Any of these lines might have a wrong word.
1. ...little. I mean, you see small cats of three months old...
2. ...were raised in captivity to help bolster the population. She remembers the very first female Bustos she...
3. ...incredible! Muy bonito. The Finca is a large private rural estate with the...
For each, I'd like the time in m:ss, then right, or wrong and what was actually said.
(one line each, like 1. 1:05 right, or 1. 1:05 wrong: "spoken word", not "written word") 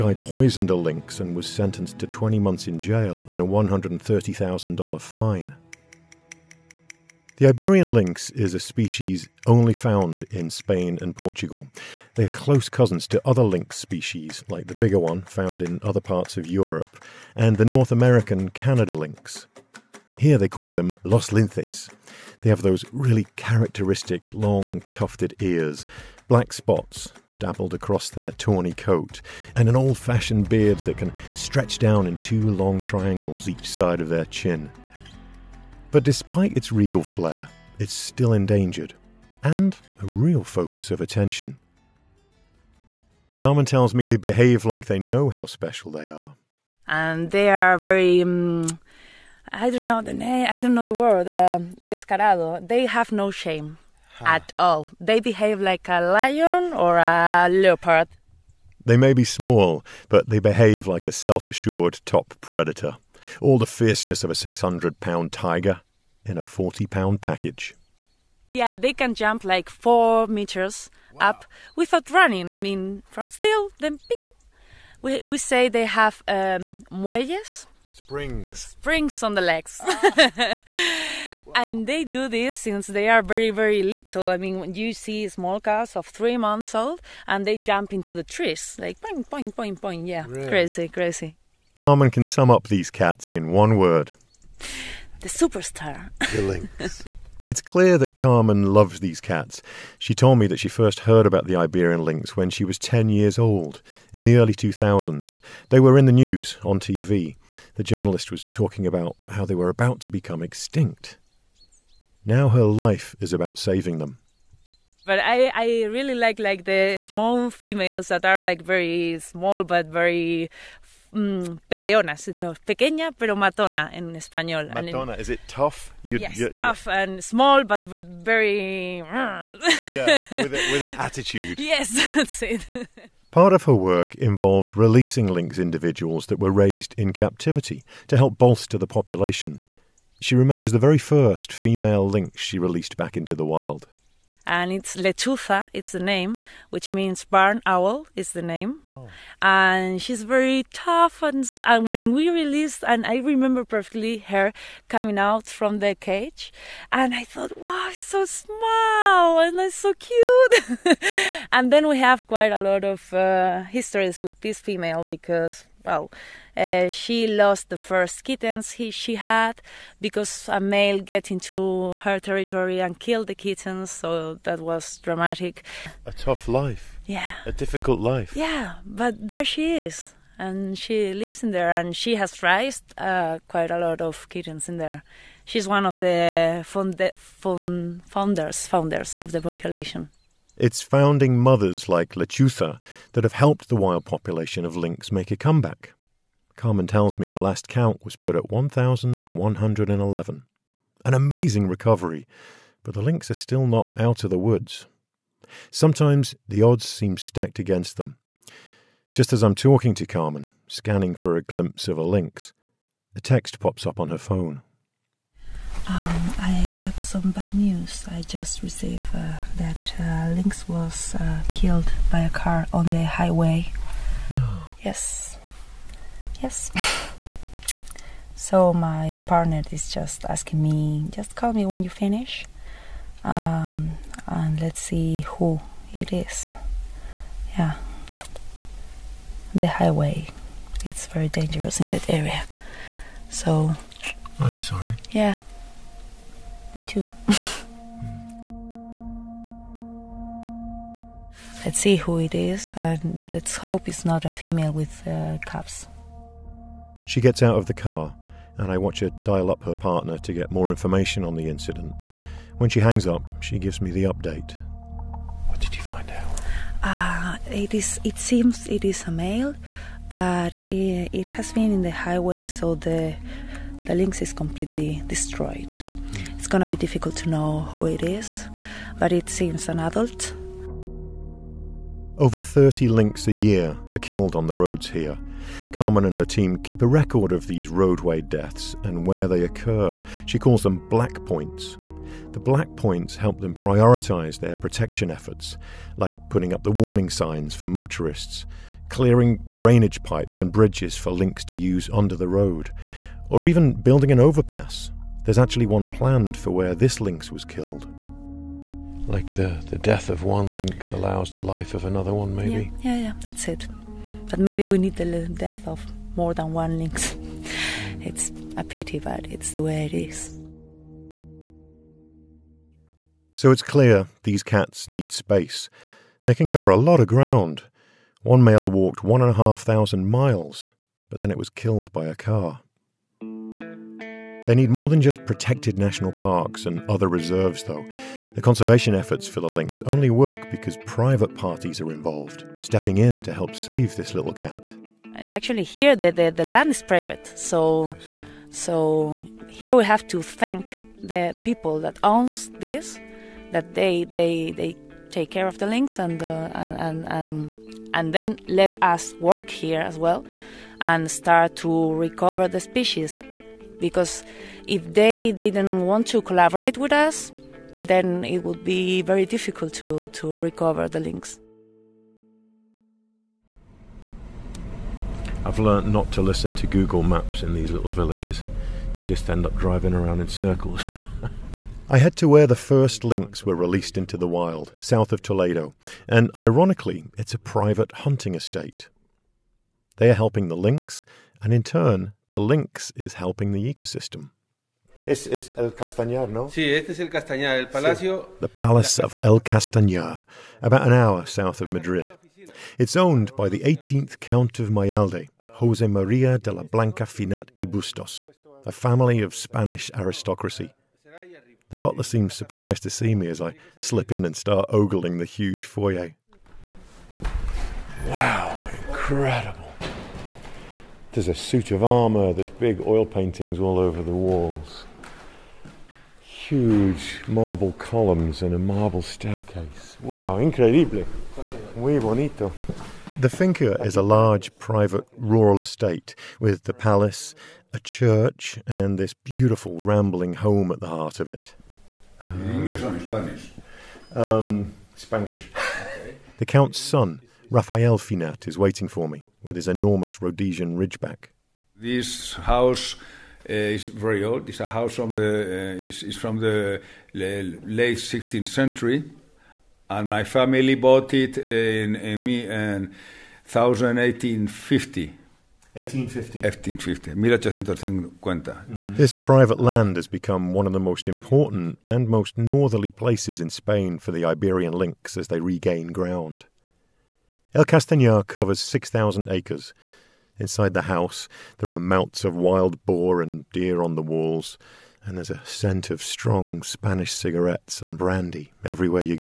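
1. 1:23 right
2. 2:16 wrong: "Lynx", not "Bustos"
3. 7:10 right.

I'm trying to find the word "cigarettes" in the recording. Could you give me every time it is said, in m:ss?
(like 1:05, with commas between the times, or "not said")
8:07.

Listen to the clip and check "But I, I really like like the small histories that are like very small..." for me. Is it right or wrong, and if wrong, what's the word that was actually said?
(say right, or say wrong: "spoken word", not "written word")
wrong: "females", not "histories".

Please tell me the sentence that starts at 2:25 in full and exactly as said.
it's the name, which means barn owl is the name.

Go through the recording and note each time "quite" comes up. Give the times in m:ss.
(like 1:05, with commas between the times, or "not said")
2:42, 3:03.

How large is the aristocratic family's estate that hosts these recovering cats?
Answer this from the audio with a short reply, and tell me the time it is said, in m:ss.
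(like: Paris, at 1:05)
6,000 acres, at 7:58.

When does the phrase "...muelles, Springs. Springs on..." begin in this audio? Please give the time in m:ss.
1:16.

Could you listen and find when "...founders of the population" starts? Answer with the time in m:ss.
3:08.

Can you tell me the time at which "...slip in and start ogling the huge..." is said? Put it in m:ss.
6:53.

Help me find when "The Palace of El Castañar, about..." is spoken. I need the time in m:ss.
6:38.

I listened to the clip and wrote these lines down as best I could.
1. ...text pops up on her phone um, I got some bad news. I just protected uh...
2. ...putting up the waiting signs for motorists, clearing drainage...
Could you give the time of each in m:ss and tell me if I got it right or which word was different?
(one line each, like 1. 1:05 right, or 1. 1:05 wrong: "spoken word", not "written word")
1. 3:33 wrong: "received", not "protected"
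2. 4:56 wrong: "warning", not "waiting".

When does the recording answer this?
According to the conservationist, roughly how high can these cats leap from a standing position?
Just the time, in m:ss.
1:09.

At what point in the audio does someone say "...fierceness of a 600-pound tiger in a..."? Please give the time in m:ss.
1:03.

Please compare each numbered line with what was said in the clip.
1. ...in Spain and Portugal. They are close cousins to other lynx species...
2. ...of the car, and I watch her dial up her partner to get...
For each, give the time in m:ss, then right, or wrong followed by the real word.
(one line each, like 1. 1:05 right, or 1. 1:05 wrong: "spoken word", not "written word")
1. 0:10 right
2. 4:17 right.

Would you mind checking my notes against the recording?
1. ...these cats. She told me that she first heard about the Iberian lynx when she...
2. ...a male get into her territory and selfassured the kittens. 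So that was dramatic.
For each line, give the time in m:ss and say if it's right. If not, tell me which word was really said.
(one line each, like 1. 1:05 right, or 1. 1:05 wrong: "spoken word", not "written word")
1. 1:38 right
2. 2:50 wrong: "killed", not "selfassured".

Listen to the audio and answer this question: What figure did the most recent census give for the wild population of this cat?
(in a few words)
1,111.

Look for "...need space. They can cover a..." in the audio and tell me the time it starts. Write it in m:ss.
5:24.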